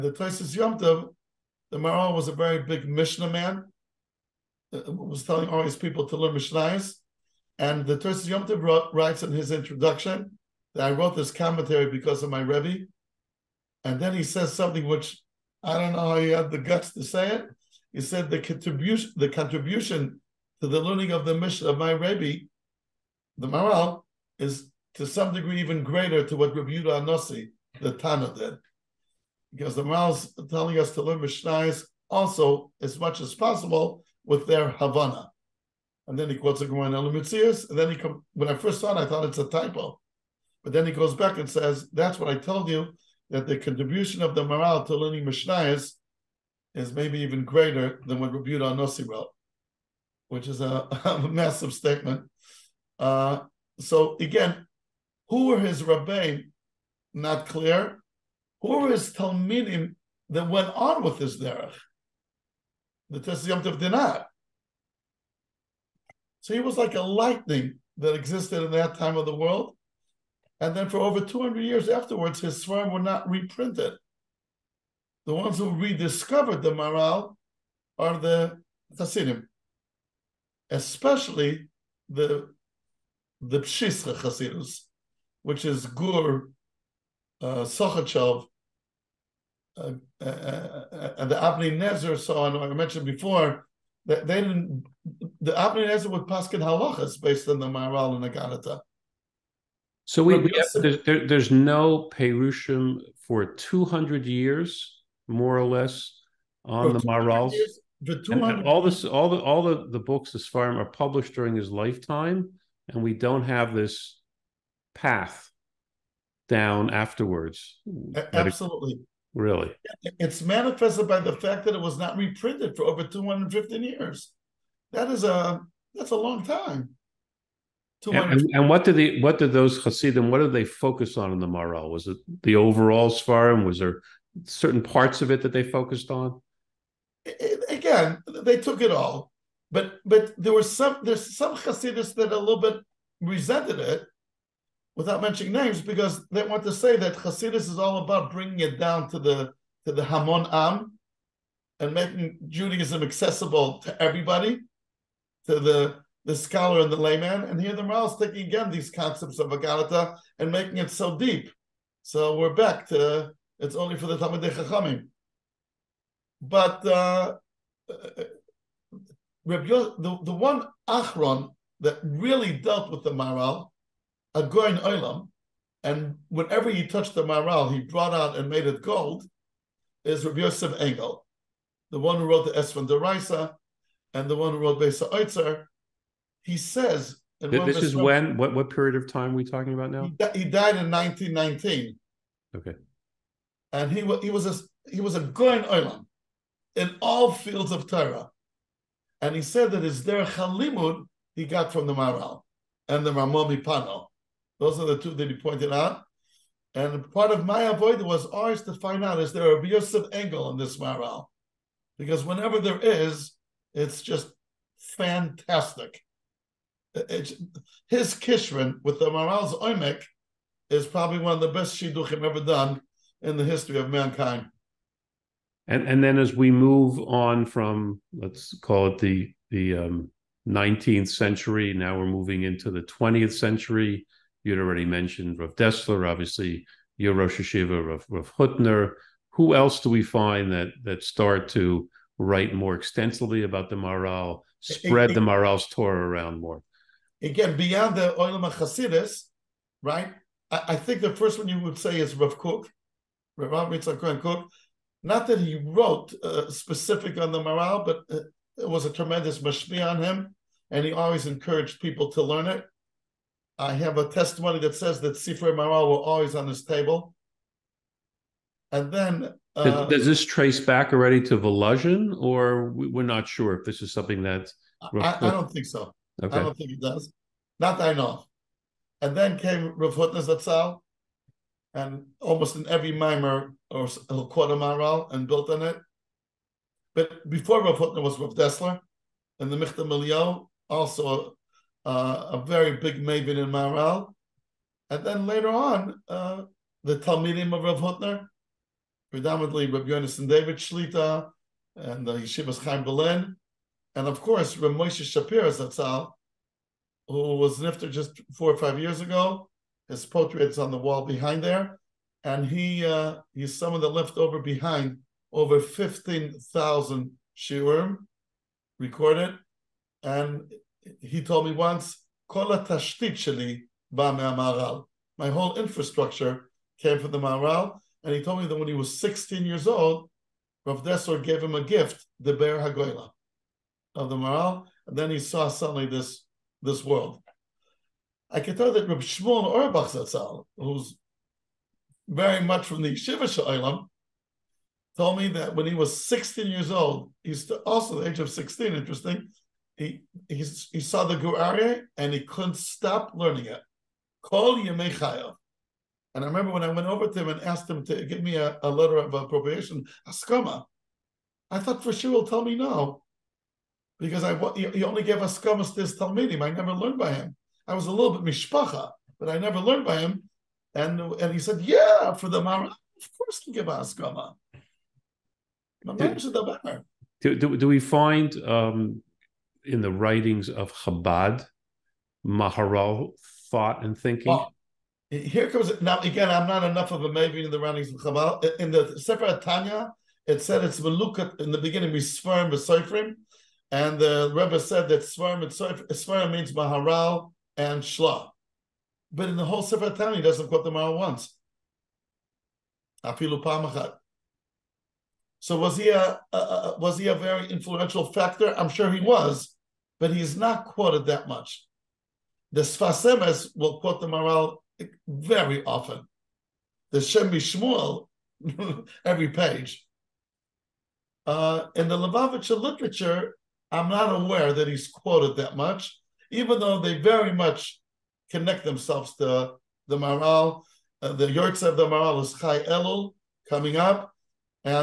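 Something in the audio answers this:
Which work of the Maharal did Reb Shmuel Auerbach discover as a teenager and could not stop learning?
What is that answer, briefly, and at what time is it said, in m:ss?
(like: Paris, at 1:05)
Gur Aryeh, at 5:51.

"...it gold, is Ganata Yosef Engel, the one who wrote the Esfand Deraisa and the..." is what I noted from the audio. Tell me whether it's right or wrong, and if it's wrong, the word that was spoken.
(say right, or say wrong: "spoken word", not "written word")
wrong: "Reb", not "Ganata".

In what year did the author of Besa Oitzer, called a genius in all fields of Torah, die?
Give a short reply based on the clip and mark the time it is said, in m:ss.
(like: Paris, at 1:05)
1919, at 3:10.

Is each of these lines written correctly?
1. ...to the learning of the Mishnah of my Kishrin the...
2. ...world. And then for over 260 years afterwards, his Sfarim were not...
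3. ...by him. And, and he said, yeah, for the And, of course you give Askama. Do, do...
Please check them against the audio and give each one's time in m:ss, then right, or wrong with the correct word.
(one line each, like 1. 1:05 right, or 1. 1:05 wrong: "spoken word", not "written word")
1. 0:20 wrong: "Rebbe", not "Kishrin"
2. 1:09 wrong: "200", not "260"
3. 6:09 wrong: "Maharal", not "And".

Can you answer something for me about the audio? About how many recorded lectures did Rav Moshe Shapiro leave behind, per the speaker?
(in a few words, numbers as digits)
15,000.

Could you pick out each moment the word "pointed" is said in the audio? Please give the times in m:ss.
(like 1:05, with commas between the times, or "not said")
3:25.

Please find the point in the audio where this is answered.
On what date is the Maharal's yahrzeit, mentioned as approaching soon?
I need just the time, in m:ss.
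7:12.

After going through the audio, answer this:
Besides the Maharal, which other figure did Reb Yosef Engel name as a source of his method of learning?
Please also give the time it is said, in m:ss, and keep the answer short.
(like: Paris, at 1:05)
Ramomi Mipano, at 3:23.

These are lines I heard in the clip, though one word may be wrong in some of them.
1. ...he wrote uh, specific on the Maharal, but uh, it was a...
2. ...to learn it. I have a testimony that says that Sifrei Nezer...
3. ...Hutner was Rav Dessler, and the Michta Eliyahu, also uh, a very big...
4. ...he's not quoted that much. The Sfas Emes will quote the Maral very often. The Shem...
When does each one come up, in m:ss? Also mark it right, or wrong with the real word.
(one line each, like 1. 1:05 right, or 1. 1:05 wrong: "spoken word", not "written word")
1. 4:15 right
2. 4:22 wrong: "Maral", not "Nezer"
3. 4:47 right
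4. 6:50 right.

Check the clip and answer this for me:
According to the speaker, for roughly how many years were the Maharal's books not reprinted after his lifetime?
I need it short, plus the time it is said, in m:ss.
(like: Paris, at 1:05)
215 years, at 2:03.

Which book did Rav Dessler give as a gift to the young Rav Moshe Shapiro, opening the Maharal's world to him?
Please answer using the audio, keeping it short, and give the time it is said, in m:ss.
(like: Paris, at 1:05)
Be'er Hagoyla, at 5:32.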